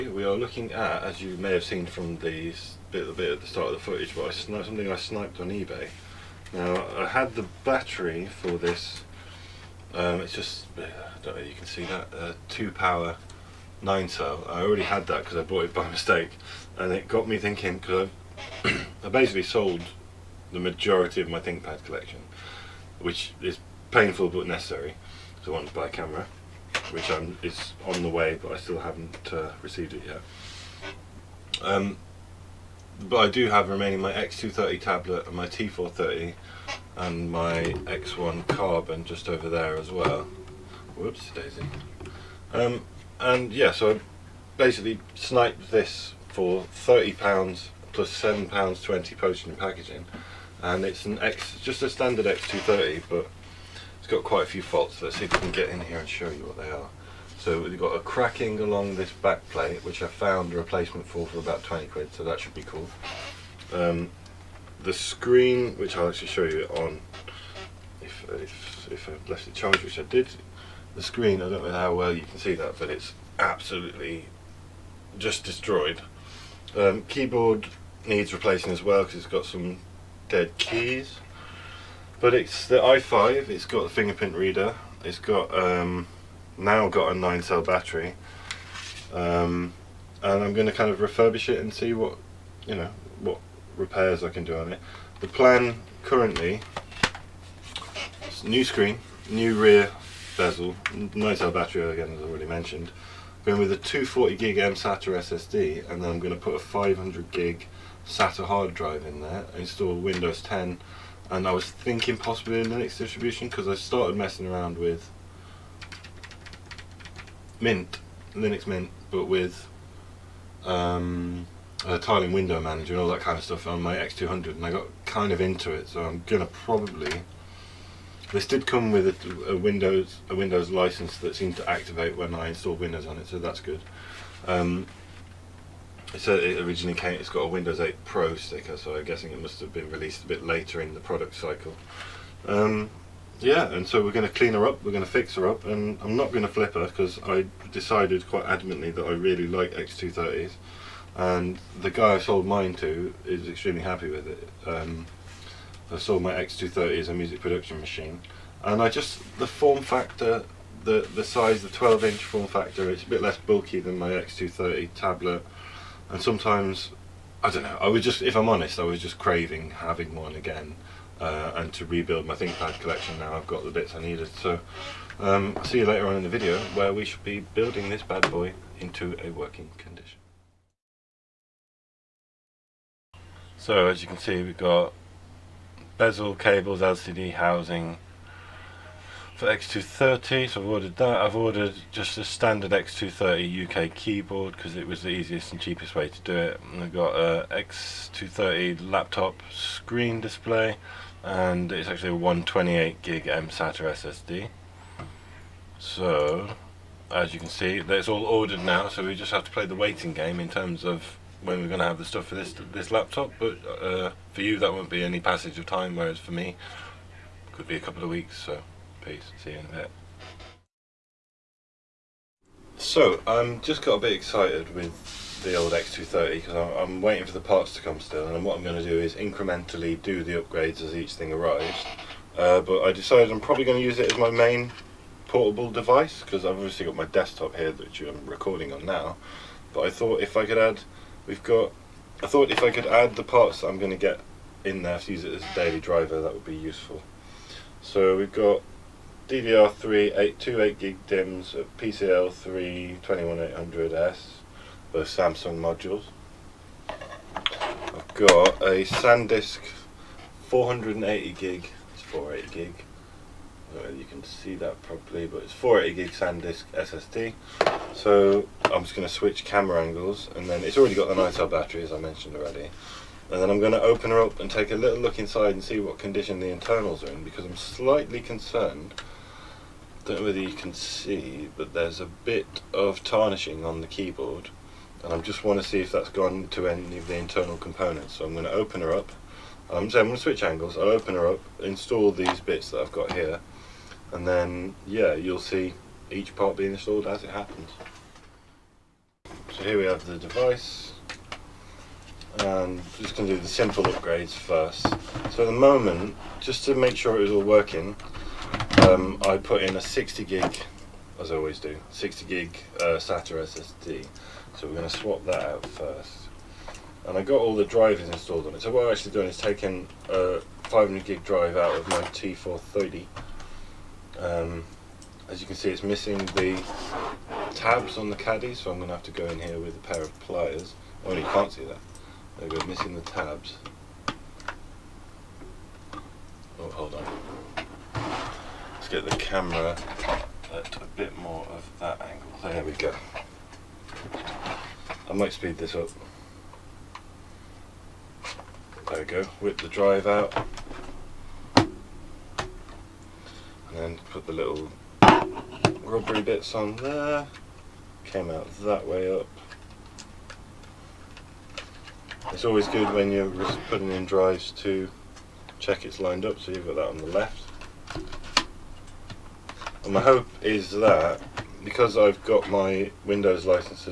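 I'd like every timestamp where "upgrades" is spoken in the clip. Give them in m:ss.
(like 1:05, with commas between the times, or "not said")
3:50, 5:03.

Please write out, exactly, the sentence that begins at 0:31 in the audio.
Um, but I do have remaining my X230 tablet and my T430 and my X1 Carbon just over there as well.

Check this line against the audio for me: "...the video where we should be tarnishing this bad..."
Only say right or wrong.
wrong.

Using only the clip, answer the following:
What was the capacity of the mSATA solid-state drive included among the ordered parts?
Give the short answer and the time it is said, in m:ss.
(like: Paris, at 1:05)
128 gig, at 3:22.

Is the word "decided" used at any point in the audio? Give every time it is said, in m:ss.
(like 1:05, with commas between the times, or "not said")
2:27, 3:52.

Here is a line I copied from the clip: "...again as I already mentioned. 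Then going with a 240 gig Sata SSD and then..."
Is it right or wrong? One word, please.
right.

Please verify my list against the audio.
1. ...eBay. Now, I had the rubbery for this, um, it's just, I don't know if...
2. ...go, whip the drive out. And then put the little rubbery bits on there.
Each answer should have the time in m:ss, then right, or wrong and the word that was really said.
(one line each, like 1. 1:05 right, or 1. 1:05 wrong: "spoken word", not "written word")
1. 0:05 wrong: "battery", not "rubbery"
2. 5:49 right.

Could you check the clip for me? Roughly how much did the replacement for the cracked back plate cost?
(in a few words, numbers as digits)
20 quid.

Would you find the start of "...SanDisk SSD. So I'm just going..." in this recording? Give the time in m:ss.
4:26.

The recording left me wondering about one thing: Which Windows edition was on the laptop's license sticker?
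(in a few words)
Windows 8 Pro.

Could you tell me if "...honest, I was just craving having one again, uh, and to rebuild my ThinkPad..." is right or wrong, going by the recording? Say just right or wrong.
right.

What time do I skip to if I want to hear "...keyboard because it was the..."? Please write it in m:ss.
3:13.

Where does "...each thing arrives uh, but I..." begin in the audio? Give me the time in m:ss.
3:50.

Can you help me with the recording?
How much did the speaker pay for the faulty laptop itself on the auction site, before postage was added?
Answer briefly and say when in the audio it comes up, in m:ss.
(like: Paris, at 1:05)
£30, at 0:46.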